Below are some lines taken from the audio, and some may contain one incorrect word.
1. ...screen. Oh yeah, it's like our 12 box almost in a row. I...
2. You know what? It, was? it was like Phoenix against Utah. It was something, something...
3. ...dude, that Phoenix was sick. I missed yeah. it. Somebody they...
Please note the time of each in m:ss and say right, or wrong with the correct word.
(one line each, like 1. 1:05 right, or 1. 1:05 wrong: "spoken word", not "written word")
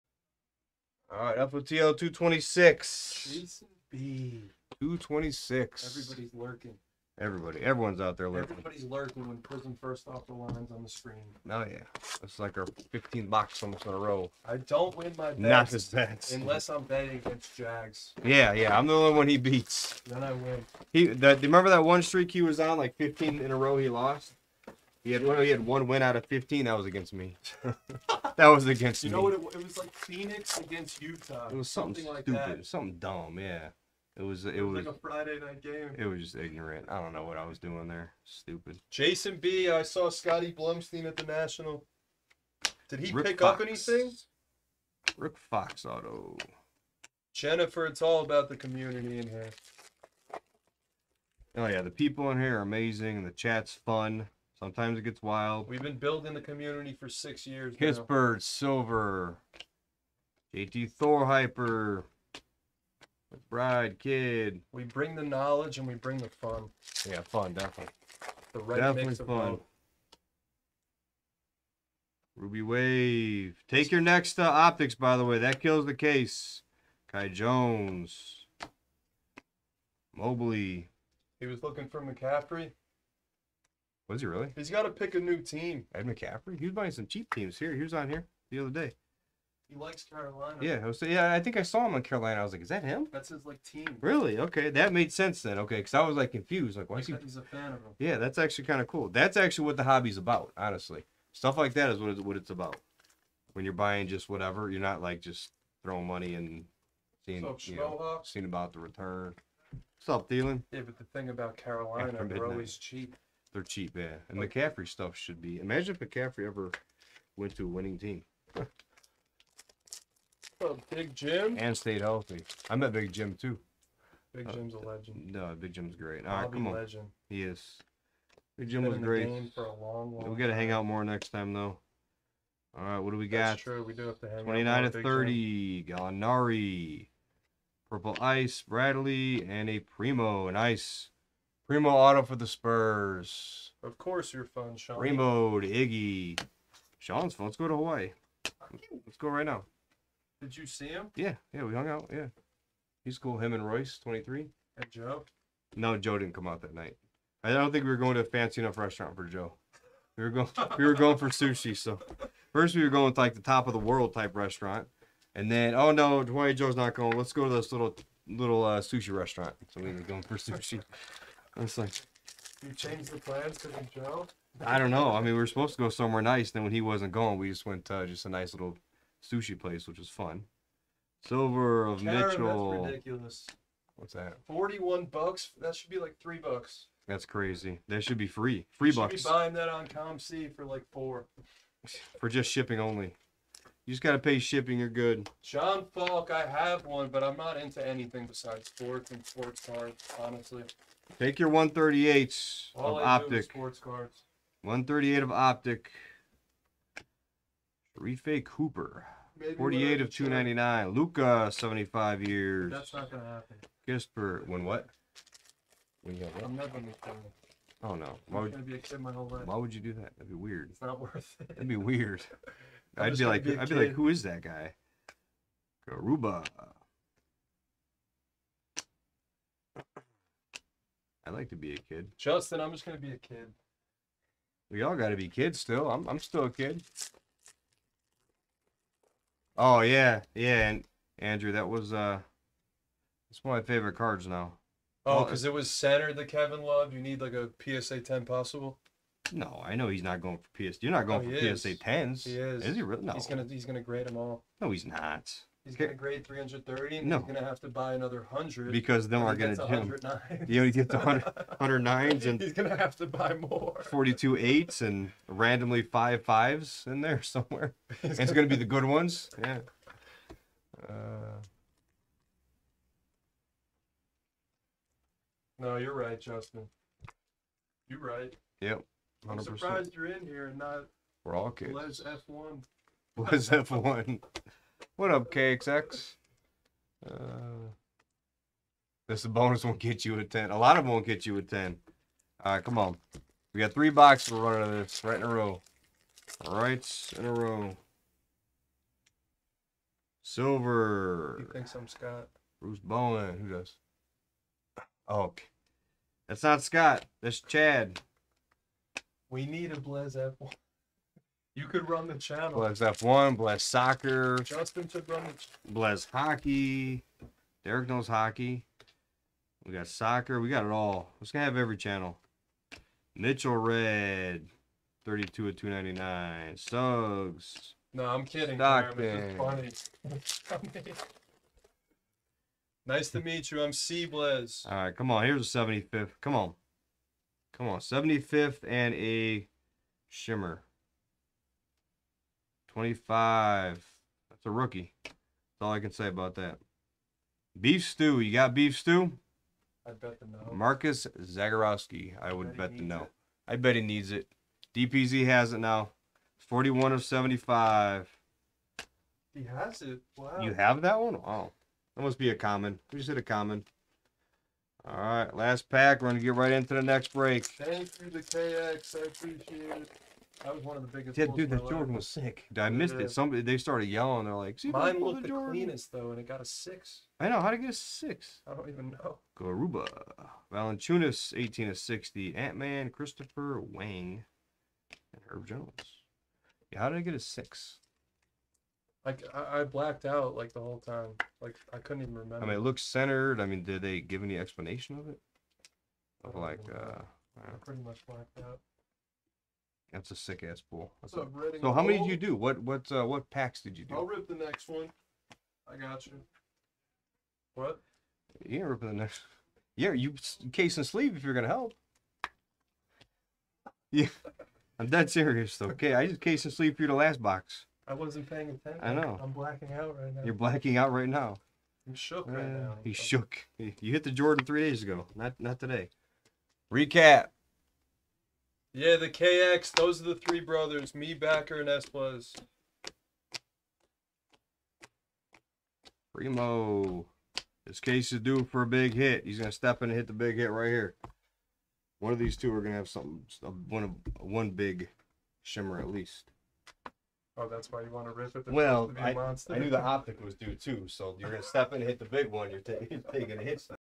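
1. 0:10 wrong: "15", not "12"
2. 0:29 right
3. 6:11 wrong: "Jordan", not "Phoenix".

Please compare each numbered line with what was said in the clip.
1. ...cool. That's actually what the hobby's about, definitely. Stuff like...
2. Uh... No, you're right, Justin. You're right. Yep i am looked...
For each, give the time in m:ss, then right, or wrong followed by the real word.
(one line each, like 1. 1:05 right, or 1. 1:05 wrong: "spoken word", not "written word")
1. 1:38 wrong: "honestly", not "definitely"
2. 4:30 wrong: "surprised", not "looked".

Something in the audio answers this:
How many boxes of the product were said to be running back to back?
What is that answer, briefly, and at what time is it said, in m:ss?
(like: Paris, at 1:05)
3, at 4:53.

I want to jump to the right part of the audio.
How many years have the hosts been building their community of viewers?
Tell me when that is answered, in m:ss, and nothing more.
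0:57.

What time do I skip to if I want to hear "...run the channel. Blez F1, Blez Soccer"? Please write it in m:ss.
5:11.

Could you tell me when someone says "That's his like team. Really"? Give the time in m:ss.
1:33.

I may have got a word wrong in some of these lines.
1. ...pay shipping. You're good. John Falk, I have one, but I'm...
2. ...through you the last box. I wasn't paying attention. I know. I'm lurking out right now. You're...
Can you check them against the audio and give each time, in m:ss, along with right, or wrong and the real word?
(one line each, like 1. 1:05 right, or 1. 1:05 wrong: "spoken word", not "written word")
1. 3:14 right
2. 6:56 wrong: "blacking", not "lurking".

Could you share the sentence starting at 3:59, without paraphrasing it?
Oh yeah, yeah, and Andrew, that was uh, it's one of my favorite cards now.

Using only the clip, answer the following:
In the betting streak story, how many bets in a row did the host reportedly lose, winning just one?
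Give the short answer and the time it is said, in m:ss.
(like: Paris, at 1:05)
15, at 0:22.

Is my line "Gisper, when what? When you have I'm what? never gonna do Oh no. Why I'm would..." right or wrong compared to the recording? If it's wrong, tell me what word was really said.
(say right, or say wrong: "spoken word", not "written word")
right.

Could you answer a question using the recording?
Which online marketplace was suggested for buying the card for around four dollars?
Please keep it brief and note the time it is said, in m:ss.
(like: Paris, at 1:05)
COMC, at 3:09.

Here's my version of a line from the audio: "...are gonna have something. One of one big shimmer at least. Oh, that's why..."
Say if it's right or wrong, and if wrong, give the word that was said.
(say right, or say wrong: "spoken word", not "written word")
right.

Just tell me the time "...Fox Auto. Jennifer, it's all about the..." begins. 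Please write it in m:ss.
0:45.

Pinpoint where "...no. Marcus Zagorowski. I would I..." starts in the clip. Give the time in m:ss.
5:50.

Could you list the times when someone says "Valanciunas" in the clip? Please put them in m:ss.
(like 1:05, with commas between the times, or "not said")
6:20.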